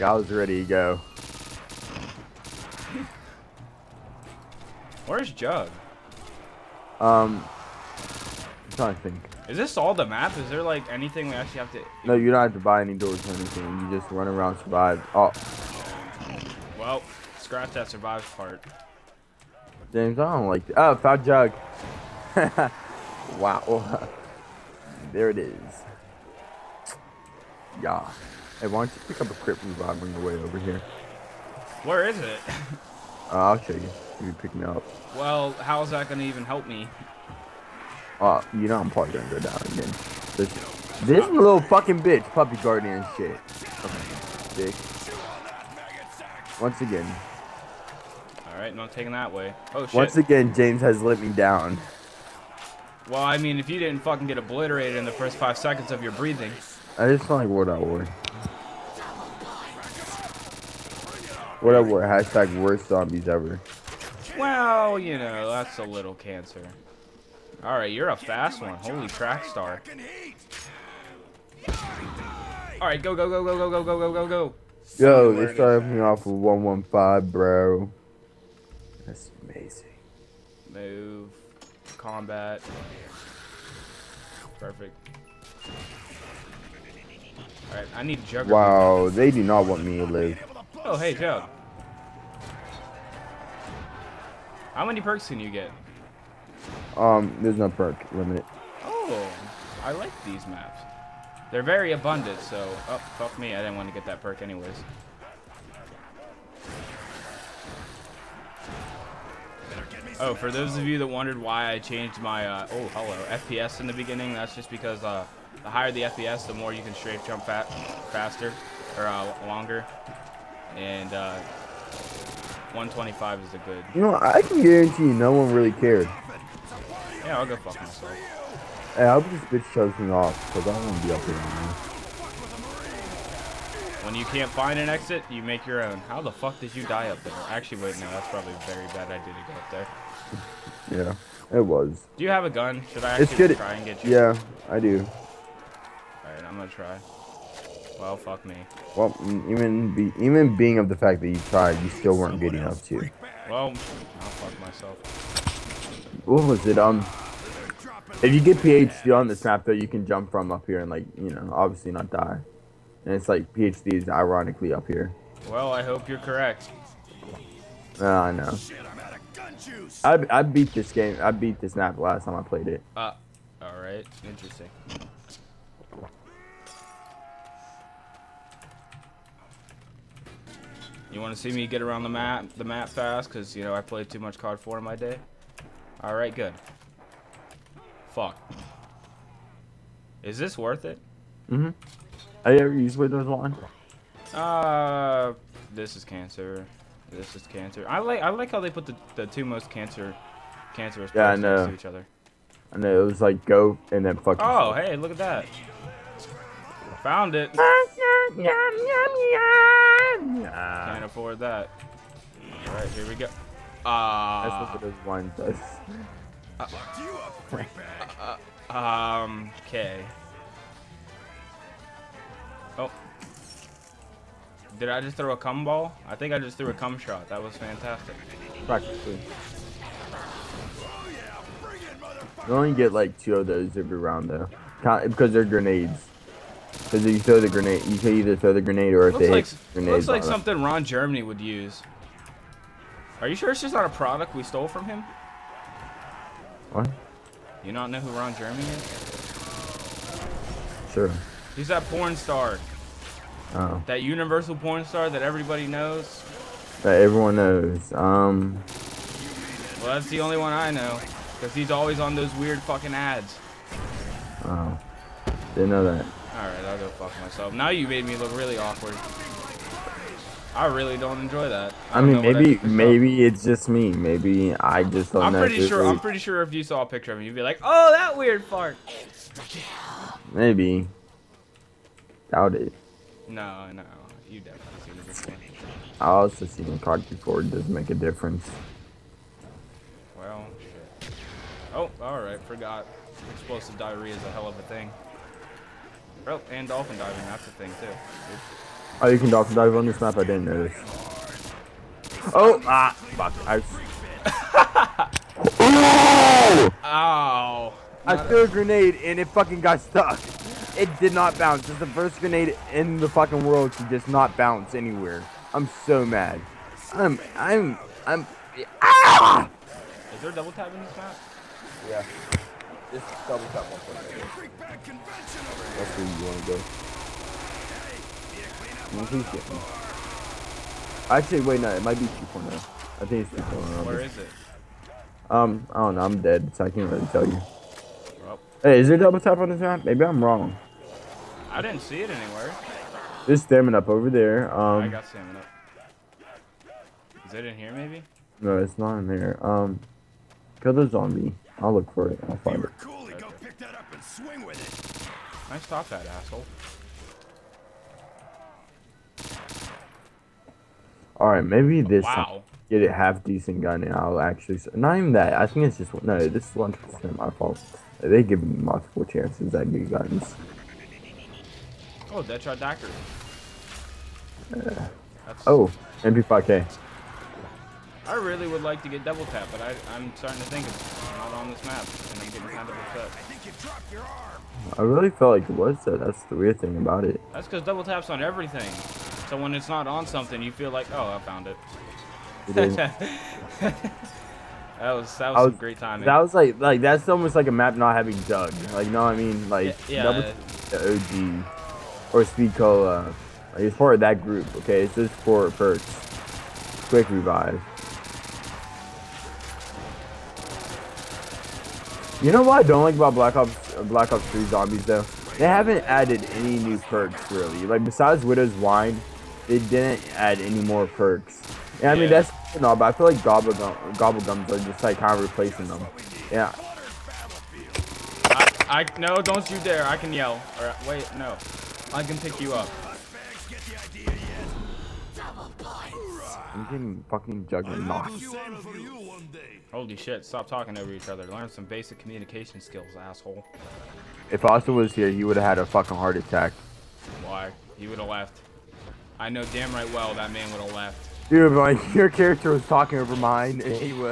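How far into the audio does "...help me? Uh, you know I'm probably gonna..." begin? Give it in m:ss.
0:36.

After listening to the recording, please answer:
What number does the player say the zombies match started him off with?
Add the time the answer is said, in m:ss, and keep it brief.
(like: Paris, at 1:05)
115, at 1:16.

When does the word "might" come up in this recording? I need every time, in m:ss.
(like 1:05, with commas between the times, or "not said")
5:31.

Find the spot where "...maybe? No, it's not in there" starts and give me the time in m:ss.
5:47.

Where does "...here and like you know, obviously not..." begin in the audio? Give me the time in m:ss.
2:40.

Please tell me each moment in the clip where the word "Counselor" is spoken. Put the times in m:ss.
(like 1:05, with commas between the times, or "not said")
not said.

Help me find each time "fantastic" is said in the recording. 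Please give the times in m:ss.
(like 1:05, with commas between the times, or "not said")
3:47.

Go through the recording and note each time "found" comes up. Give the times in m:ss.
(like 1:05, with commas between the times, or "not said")
0:20, 3:26, 6:31.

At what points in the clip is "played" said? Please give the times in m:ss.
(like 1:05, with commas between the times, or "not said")
2:52, 3:03.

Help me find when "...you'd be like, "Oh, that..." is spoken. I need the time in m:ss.
4:37.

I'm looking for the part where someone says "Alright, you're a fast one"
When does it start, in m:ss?
1:07.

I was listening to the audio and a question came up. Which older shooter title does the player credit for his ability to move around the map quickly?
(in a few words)
COD 4.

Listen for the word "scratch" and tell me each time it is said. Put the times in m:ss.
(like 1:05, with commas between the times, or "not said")
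0:17.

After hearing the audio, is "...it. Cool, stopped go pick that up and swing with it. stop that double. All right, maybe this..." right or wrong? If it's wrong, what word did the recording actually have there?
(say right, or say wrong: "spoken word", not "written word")
wrong: "asshole", not "double".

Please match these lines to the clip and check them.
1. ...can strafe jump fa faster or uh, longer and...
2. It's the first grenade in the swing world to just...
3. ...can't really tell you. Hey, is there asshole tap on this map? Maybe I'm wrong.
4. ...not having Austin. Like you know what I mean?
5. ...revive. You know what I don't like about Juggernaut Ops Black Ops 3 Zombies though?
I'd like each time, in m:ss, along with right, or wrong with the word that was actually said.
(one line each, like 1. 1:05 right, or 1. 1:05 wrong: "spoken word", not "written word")
1. 1:56 right
2. 5:11 wrong: "fucking", not "swing"
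3. 5:36 wrong: "double", not "asshole"
4. 6:37 wrong: "Jug", not "Austin"
5. 6:47 wrong: "Black", not "Juggernaut".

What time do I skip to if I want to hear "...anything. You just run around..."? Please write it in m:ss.
0:13.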